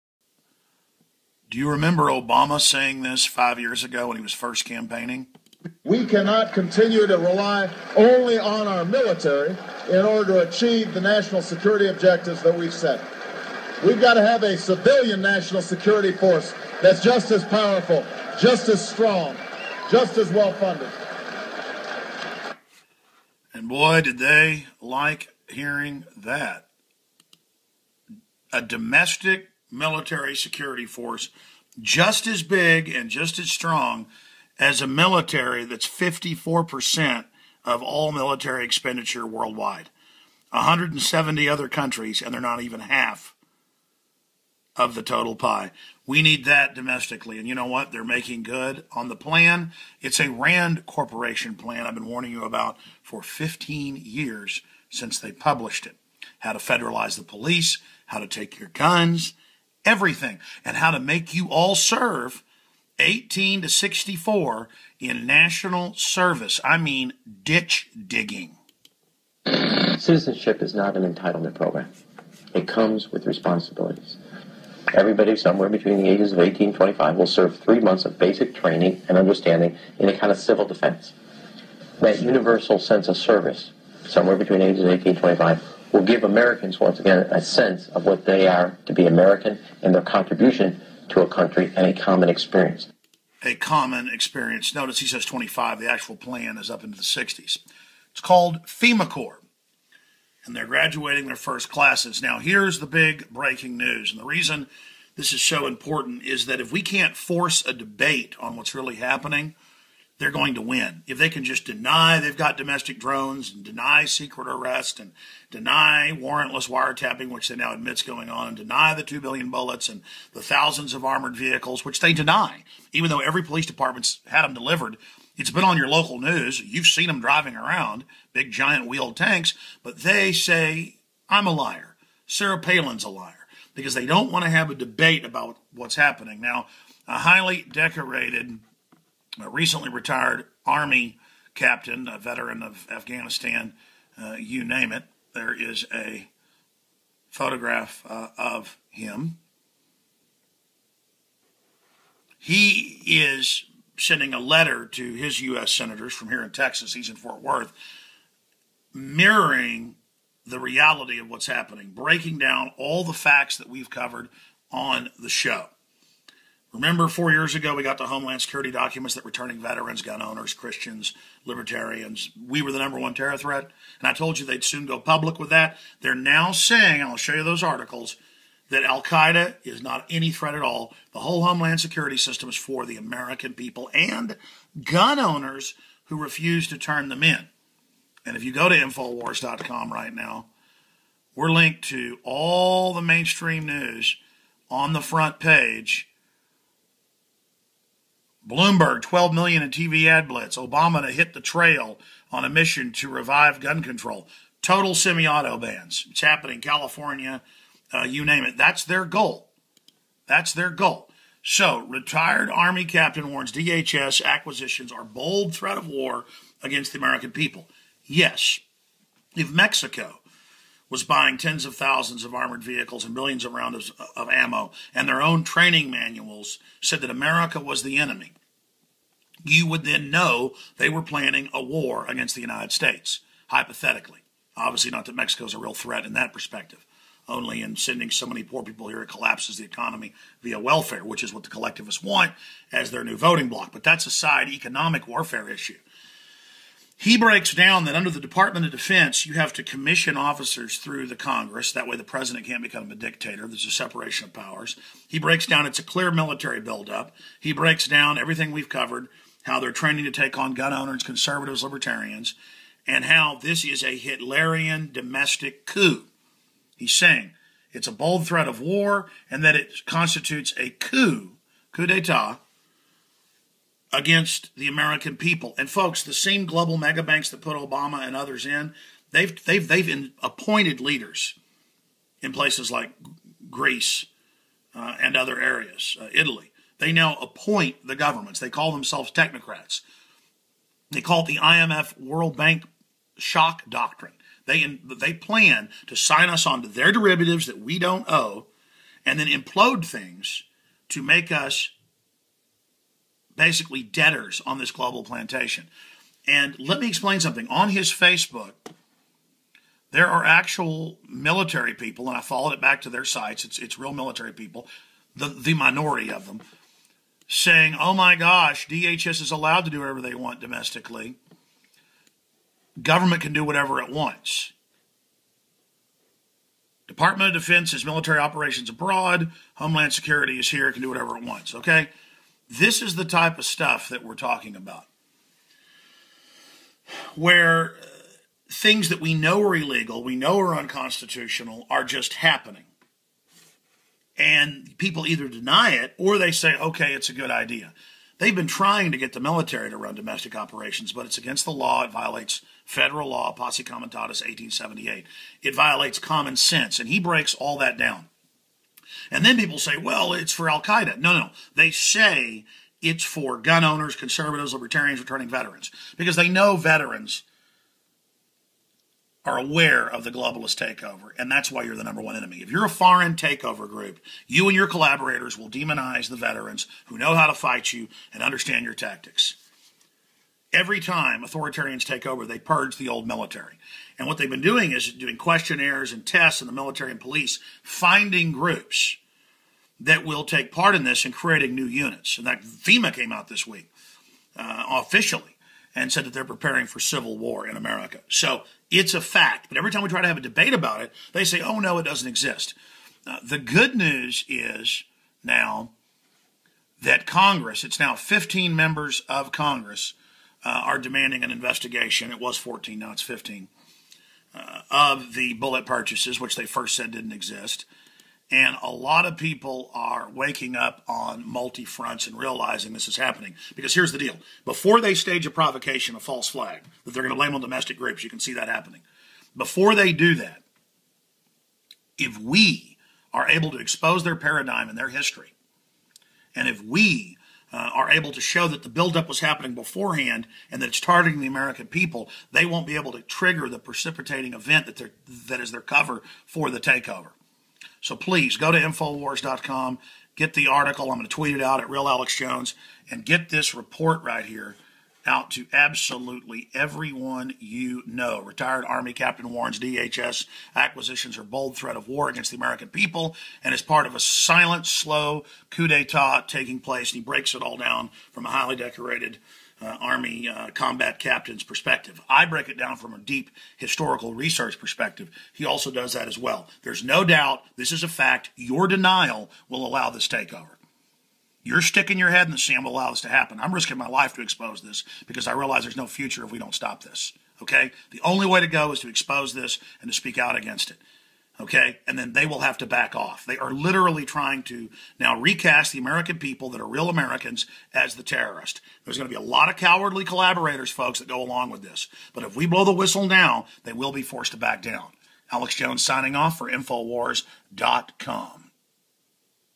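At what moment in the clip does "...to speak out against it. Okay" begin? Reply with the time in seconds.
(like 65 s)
489 s.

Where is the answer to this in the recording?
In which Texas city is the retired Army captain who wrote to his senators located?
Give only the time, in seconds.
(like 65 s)
157 s.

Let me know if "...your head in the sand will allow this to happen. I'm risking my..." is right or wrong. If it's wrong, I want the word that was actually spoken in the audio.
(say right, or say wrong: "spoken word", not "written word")
right.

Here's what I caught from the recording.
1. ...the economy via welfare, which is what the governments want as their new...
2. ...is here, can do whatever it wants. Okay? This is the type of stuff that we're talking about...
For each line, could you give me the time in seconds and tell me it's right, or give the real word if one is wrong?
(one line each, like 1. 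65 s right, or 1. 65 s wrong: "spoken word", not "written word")
1. 239 s wrong: "collectivists", not "governments"
2. 330 s right.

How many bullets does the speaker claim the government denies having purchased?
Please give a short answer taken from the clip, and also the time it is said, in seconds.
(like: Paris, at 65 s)
2 billion, at 119 s.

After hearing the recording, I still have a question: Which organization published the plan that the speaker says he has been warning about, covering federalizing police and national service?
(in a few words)
RAND Corporation.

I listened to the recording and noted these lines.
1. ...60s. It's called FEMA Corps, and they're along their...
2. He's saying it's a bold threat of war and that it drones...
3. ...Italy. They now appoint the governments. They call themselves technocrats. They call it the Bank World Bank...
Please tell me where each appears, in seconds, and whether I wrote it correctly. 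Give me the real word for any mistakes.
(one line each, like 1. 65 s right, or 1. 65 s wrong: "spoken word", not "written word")
1. 97 s wrong: "graduating", not "along"
2. 266 s wrong: "constitutes", not "drones"
3. 286 s wrong: "IMF", not "Bank".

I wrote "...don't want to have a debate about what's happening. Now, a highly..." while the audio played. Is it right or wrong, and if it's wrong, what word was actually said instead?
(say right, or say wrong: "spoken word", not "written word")
right.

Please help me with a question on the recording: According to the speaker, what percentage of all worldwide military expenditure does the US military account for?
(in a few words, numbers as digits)
54%.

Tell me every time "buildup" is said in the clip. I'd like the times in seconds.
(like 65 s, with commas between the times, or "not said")
256 s, 438 s.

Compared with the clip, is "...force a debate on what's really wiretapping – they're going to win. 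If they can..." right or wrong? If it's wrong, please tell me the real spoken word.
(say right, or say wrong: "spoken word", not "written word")
wrong: "happening", not "wiretapping".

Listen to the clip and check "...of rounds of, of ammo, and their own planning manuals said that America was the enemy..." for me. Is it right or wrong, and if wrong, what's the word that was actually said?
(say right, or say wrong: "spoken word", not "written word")
wrong: "training", not "planning".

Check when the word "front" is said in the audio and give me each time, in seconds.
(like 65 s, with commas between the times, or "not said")
195 s, 421 s.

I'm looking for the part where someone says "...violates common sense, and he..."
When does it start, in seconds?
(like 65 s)
355 s.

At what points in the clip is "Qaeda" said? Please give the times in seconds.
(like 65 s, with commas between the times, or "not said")
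179 s, 360 s.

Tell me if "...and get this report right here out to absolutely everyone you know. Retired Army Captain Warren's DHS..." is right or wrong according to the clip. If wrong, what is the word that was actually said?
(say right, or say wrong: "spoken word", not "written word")
right.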